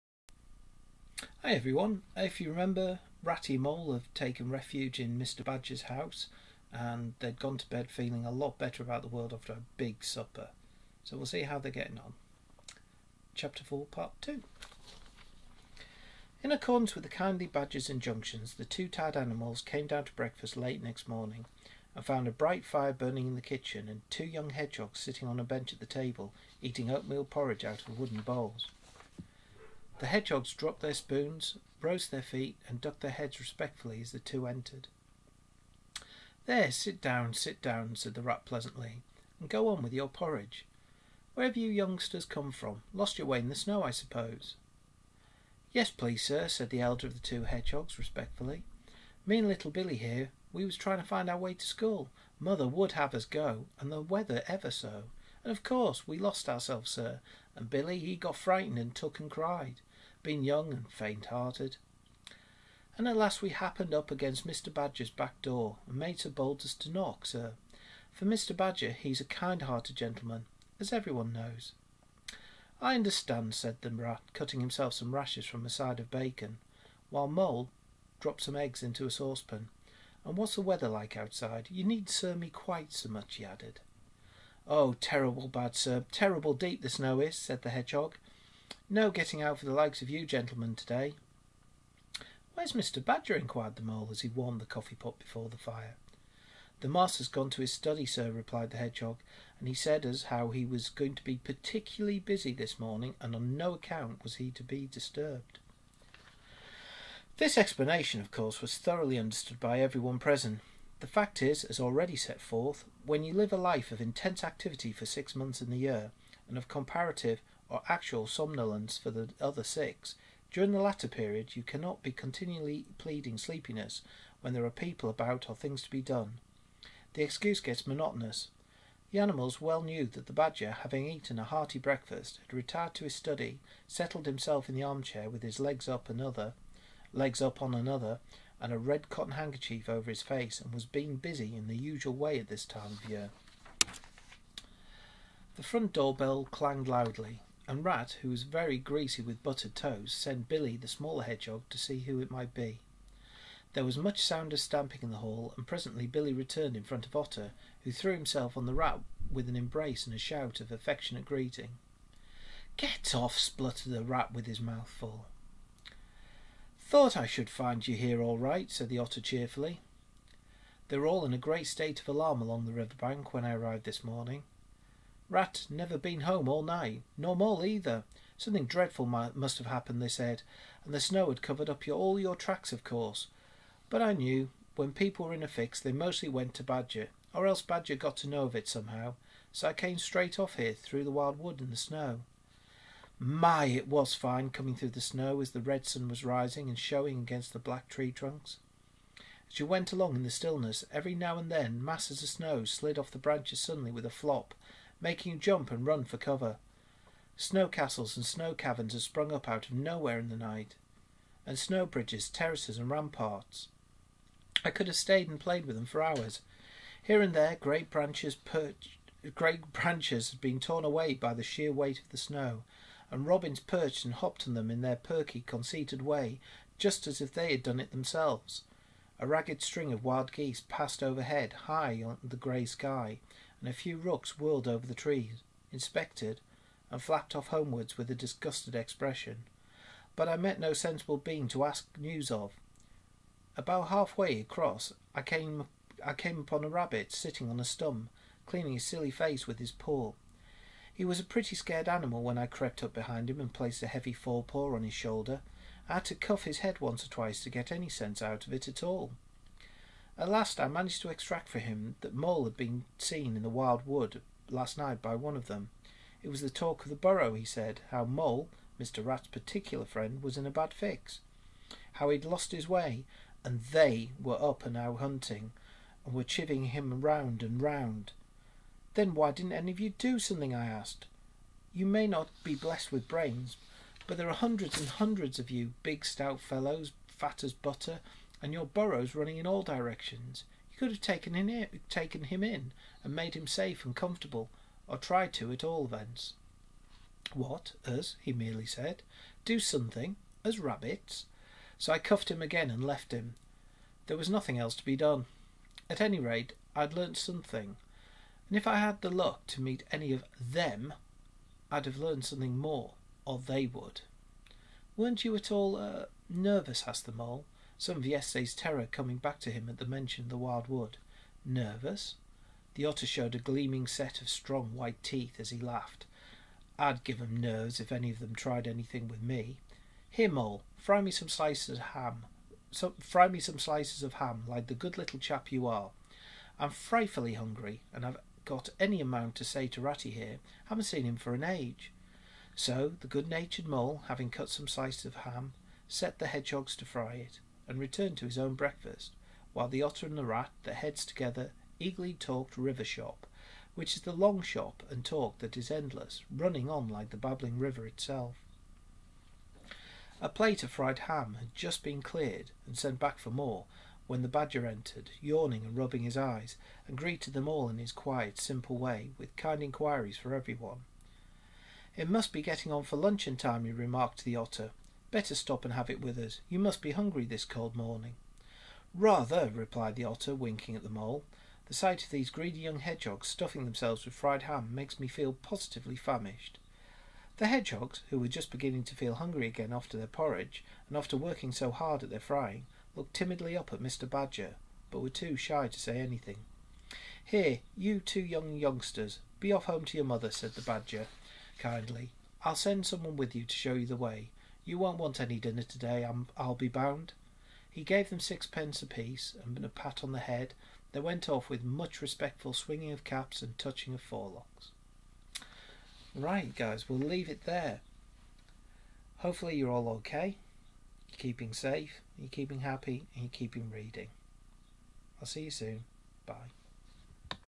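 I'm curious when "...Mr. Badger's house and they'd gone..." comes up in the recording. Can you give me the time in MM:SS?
00:05.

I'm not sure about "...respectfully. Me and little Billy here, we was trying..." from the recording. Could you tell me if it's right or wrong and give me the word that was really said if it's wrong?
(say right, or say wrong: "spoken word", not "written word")
right.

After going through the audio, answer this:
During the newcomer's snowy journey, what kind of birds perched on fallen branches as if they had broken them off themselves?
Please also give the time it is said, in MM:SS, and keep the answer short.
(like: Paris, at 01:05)
robins, at 03:43.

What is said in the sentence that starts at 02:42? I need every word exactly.
Get off, spluttered the rat with his mouth full.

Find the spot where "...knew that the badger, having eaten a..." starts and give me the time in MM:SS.
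02:09.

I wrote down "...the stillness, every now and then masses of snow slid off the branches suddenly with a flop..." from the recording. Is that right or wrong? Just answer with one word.
right.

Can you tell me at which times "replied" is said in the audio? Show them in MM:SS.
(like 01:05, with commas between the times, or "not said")
01:38, 06:19.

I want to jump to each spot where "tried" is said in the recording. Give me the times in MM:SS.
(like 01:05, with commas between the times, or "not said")
04:54, 05:28.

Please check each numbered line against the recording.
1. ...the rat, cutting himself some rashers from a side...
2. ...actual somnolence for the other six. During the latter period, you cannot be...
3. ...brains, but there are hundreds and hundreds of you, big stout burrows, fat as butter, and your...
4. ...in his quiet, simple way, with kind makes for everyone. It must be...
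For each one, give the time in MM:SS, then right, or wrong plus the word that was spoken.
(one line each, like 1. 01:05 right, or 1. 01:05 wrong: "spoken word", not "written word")
1. 01:13 right
2. 01:57 right
3. 04:43 wrong: "fellows", not "burrows"
4. 06:07 wrong: "inquiries", not "makes".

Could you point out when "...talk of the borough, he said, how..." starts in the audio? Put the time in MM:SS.
04:26.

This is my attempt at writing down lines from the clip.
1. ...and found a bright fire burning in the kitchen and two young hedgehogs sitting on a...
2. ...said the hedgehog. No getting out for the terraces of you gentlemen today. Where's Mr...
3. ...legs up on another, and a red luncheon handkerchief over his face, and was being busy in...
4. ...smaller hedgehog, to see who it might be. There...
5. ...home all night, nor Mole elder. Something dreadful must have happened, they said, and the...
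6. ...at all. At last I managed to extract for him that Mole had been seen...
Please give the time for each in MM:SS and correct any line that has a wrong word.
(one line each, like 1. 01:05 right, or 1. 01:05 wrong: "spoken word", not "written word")
1. 00:21 right
2. 01:27 wrong: "likes", not "terraces"
3. 02:17 wrong: "cotton", not "luncheon"
4. 02:30 right
5. 02:56 wrong: "either", not "elder"
6. 04:18 right.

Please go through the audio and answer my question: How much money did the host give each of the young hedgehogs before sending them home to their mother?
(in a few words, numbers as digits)
sixpence.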